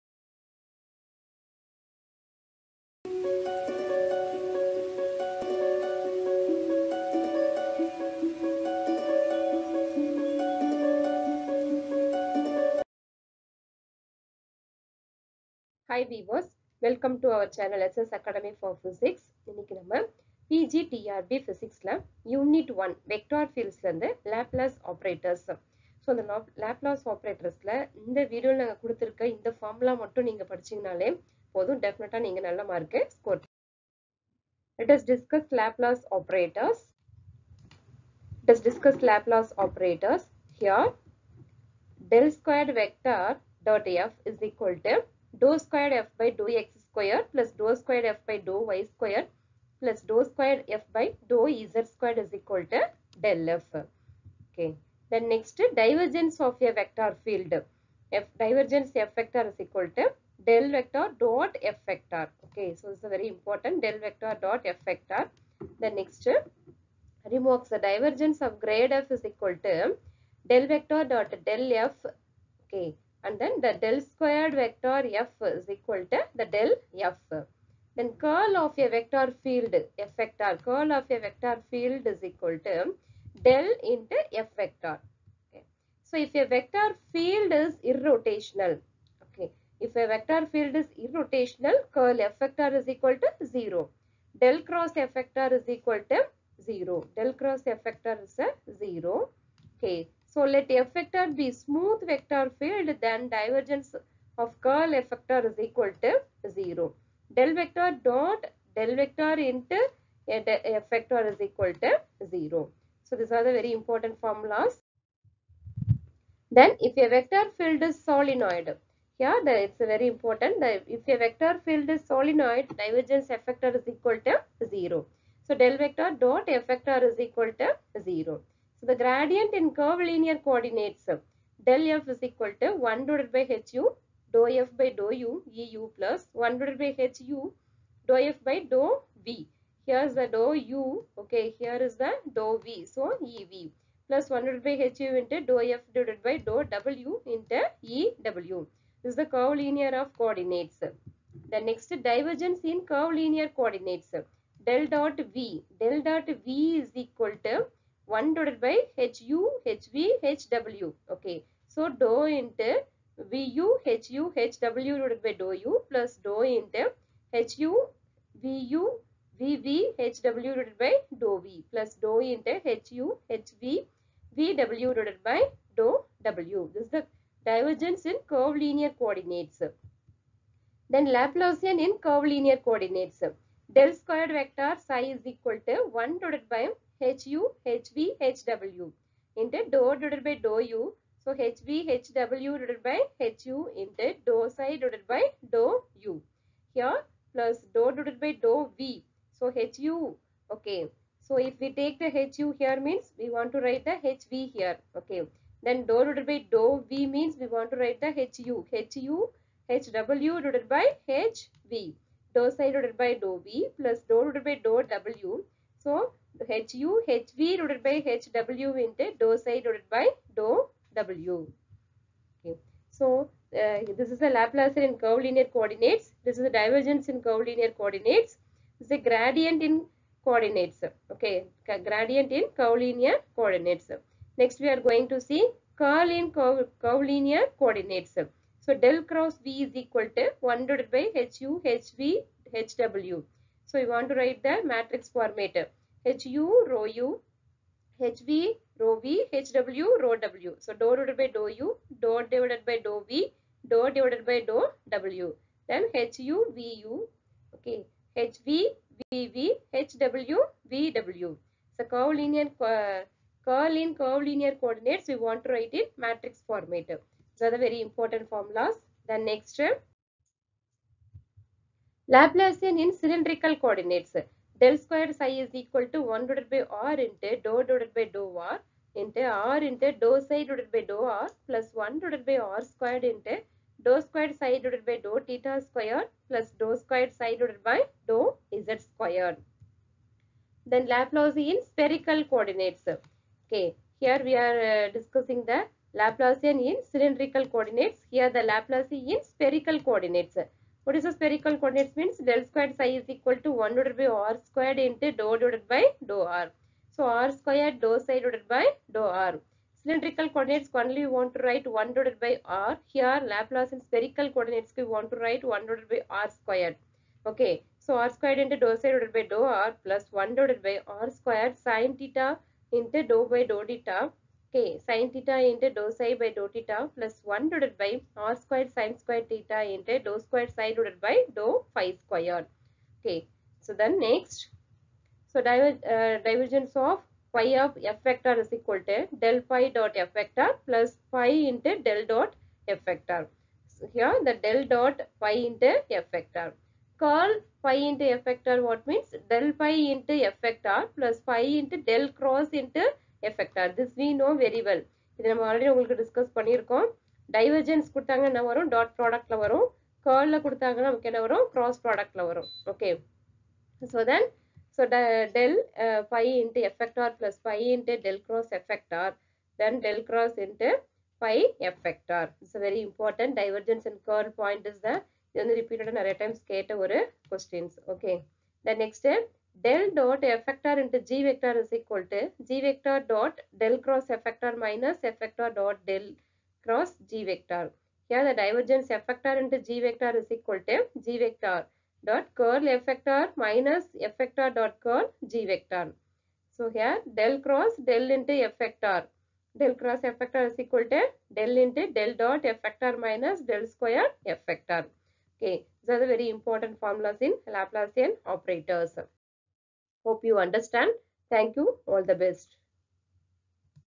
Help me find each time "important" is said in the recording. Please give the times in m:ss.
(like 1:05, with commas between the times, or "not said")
1:03, 1:53, 2:00, 4:27, 6:46.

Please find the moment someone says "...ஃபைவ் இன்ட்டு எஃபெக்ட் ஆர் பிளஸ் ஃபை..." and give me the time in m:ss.
6:06.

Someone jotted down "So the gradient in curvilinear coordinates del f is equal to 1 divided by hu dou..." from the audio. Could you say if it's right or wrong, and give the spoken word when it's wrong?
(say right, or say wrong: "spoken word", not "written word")
right.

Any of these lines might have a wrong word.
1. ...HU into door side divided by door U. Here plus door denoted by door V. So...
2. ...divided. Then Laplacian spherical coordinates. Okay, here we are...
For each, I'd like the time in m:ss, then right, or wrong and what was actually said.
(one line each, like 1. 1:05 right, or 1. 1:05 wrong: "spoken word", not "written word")
1. 3:13 wrong: "divided", not "denoted"
2. 4:48 wrong: "squared", not "divided".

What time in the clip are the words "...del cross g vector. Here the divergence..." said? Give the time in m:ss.
6:25.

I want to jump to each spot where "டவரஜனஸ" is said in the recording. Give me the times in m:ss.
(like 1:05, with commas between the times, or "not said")
5:57, 6:13.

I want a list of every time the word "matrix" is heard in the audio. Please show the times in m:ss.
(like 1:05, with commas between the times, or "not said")
4:04, 4:25.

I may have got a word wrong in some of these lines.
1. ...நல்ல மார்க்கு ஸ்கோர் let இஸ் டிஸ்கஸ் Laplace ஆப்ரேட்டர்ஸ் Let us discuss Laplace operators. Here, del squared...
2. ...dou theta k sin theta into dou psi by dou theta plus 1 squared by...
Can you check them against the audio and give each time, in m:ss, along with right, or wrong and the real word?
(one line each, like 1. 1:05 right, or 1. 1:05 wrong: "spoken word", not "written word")
1. 0:32 right
2. 5:23 wrong: "divided", not "squared".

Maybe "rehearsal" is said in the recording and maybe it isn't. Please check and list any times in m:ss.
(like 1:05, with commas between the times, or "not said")
not said.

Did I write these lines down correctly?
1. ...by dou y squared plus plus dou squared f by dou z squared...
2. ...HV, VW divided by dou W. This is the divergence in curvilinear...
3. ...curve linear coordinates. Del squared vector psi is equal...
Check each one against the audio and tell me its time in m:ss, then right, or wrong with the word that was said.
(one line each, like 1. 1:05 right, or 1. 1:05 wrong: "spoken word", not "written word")
1. 0:48 right
2. 2:53 right
3. 3:01 right.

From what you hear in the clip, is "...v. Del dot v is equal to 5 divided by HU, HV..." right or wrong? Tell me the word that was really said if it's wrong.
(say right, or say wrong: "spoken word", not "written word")
wrong: "1", not "5".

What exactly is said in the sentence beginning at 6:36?
So here del cross del into f vector.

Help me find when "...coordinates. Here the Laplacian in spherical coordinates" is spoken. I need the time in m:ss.
4:57.